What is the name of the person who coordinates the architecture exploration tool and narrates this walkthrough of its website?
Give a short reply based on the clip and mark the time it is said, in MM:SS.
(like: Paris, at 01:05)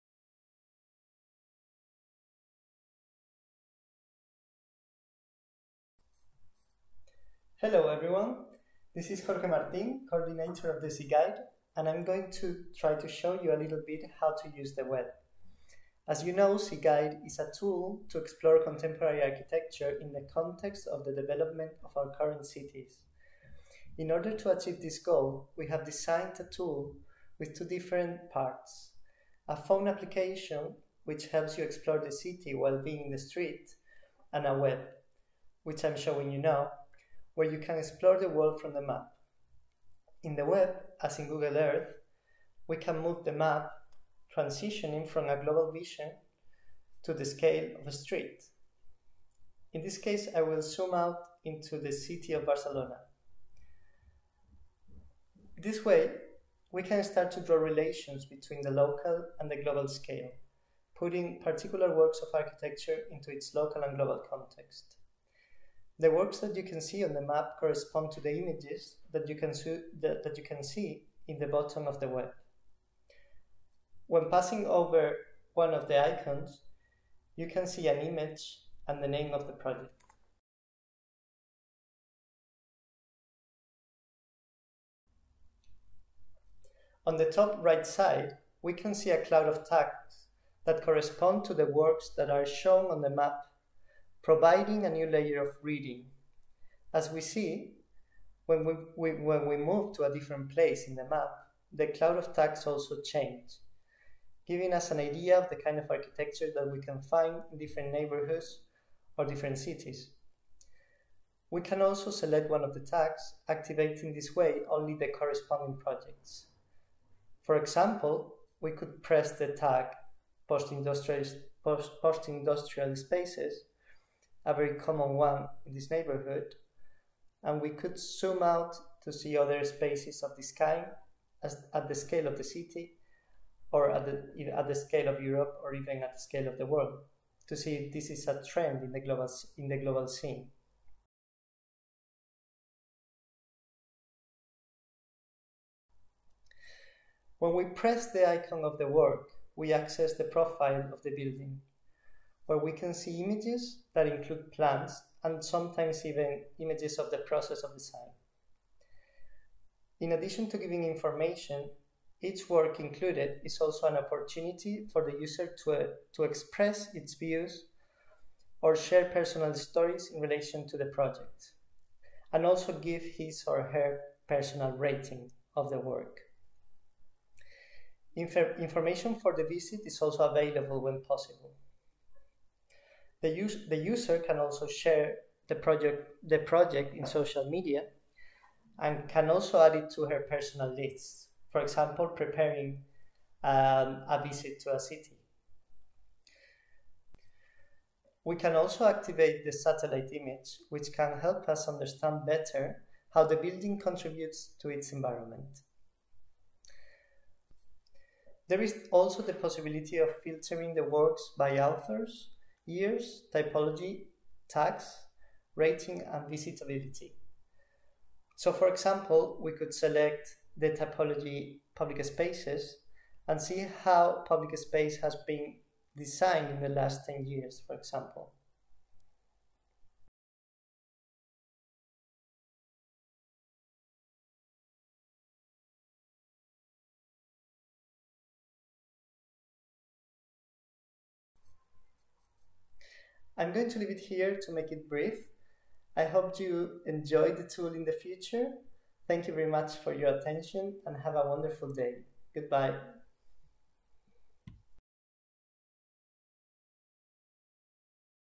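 Jorge Martin, at 00:09.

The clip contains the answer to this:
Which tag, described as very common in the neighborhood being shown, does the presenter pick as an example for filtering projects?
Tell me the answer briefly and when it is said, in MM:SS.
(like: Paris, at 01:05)
post-industrial spaces, at 02:02.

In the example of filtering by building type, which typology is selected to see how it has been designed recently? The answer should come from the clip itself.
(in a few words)
public spaces.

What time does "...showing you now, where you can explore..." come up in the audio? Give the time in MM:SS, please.
00:35.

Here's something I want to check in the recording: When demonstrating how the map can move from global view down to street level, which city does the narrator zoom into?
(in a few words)
Barcelona.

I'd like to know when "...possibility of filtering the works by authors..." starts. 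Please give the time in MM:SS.
03:29.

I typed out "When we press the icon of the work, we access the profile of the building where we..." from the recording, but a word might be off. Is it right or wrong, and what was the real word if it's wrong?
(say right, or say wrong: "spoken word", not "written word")
right.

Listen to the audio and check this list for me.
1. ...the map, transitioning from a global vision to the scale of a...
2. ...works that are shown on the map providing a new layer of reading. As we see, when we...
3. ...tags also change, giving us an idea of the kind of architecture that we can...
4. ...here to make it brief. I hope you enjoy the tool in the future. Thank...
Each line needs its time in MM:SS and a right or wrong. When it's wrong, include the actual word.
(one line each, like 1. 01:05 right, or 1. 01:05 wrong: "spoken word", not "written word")
1. 00:43 right
2. 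01:31 right
3. 01:42 right
4. 04:03 right.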